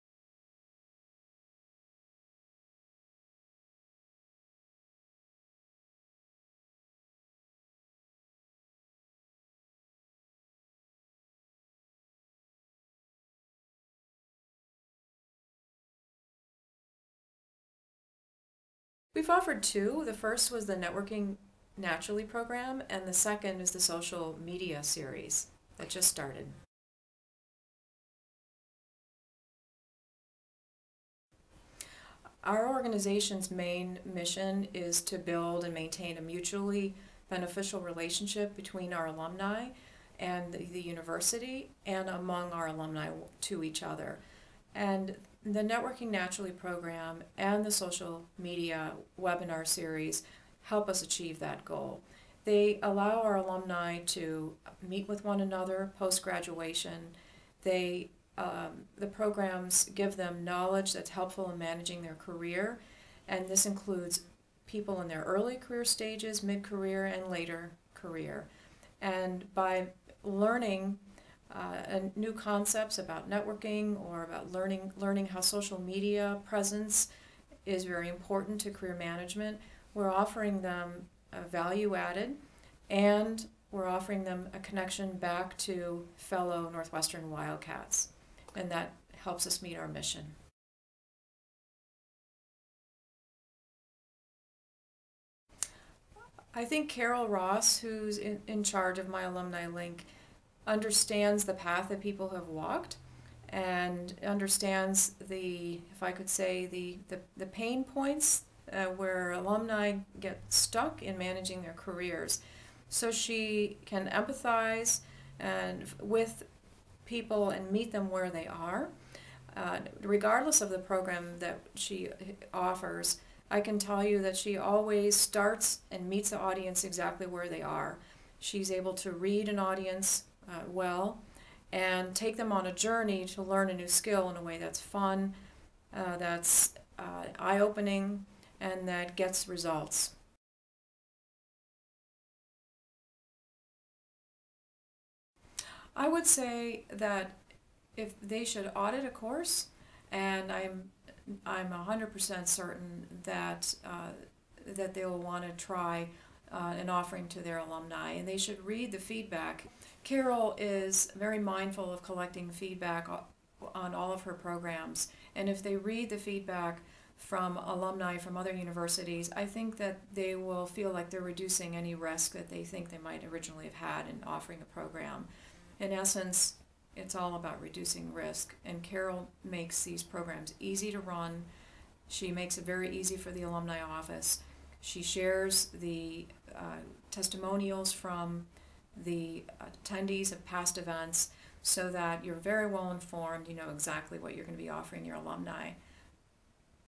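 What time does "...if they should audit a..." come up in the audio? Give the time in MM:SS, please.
02:27.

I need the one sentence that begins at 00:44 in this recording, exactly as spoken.
And the Networking Naturally program and the social media webinar series help us achieve that goal.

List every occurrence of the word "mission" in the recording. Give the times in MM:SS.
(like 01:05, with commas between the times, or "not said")
00:34, 01:29.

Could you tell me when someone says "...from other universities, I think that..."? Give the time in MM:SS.
02:48.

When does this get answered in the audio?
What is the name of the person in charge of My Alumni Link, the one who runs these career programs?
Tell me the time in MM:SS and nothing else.
01:36.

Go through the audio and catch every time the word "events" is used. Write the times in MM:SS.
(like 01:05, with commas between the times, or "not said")
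03:10.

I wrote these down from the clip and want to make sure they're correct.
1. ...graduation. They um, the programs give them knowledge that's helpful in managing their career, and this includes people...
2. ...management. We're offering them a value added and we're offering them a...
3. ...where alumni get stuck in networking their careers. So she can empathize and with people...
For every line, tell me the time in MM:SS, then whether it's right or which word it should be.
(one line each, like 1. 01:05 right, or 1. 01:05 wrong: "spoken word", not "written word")
1. 00:56 right
2. 01:18 right
3. 01:48 wrong: "managing", not "networking".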